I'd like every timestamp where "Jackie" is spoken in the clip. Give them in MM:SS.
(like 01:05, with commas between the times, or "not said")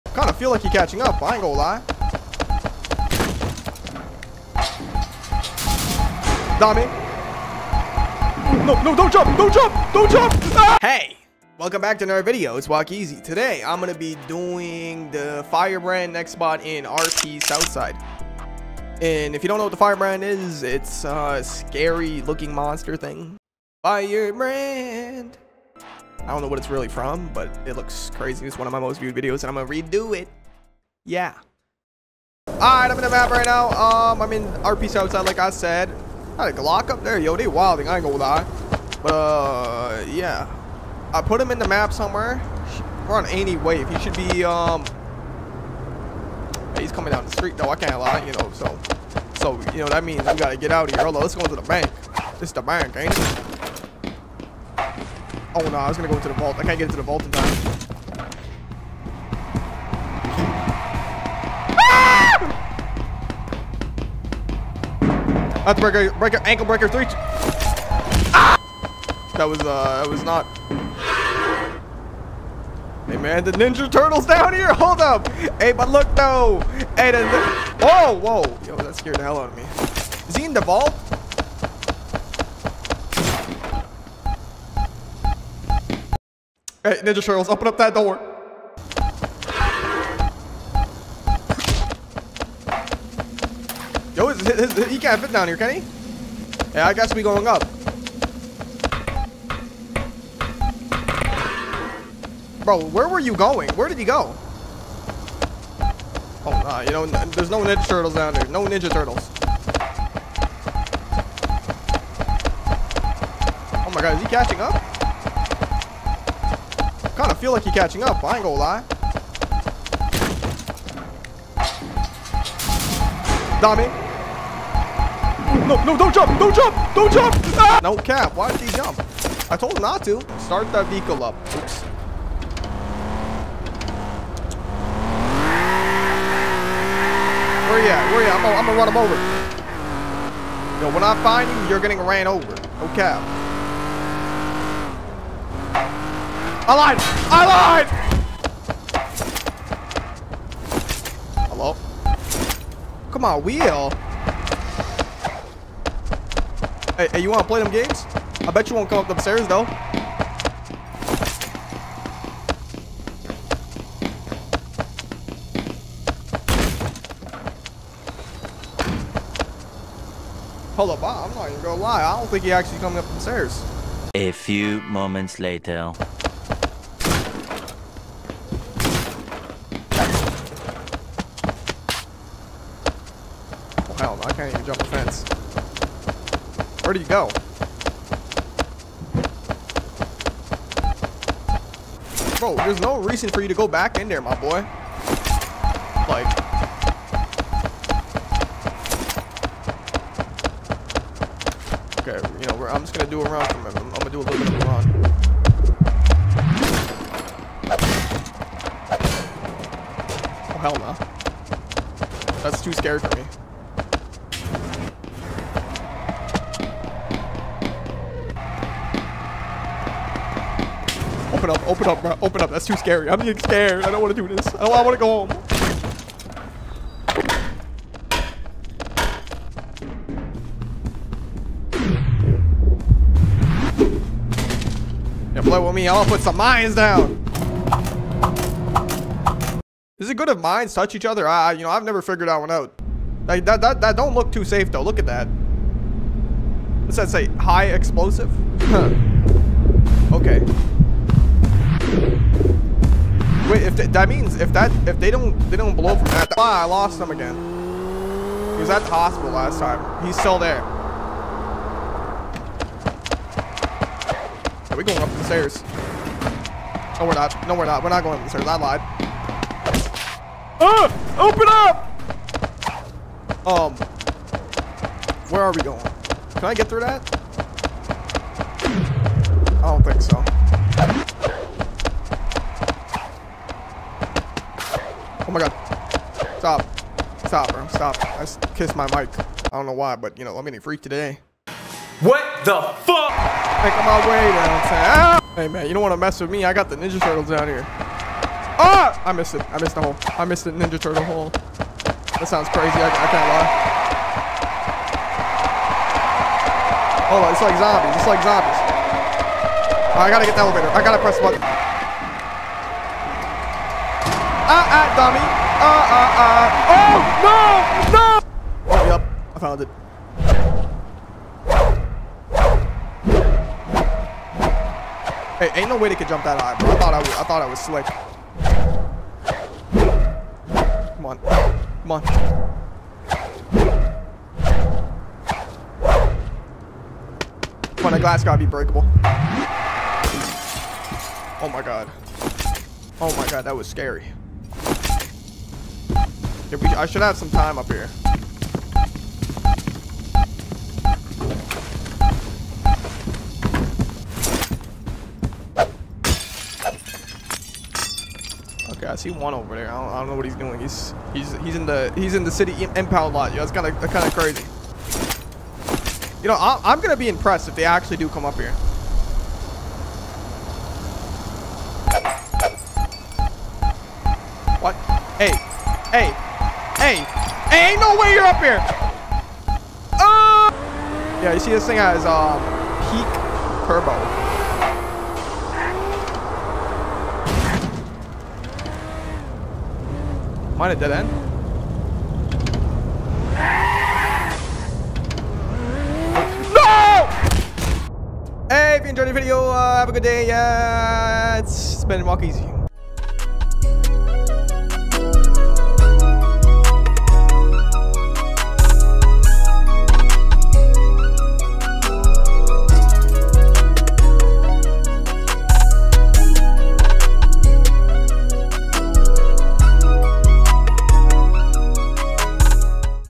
not said.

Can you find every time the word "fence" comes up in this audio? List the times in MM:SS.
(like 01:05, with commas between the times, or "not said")
03:04.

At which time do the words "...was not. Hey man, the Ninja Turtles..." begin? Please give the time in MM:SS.
01:10.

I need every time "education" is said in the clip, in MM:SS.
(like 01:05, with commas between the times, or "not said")
not said.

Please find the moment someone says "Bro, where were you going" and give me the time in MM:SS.
01:42.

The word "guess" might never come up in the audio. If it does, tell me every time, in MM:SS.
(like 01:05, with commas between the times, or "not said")
01:36.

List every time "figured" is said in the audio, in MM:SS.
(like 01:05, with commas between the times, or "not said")
04:02.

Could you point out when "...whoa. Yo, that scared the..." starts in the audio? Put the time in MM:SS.
01:18.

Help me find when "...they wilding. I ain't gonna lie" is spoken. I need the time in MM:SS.
00:37.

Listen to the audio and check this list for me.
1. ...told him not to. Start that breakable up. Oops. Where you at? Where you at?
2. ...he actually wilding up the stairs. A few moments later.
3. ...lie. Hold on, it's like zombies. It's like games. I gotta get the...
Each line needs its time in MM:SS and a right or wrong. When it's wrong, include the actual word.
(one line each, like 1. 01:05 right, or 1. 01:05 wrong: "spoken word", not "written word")
1. 02:09 wrong: "vehicle", not "breakable"
2. 02:52 wrong: "coming", not "wilding"
3. 05:03 wrong: "zombies", not "games".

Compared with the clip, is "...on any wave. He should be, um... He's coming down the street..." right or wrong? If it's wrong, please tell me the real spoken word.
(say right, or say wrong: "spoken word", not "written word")
right.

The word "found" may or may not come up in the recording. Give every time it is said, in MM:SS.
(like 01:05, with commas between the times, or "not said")
05:19.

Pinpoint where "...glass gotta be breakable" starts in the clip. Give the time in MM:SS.
05:37.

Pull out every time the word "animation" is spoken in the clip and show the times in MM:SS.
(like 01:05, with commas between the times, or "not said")
not said.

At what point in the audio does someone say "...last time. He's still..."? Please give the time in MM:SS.
04:19.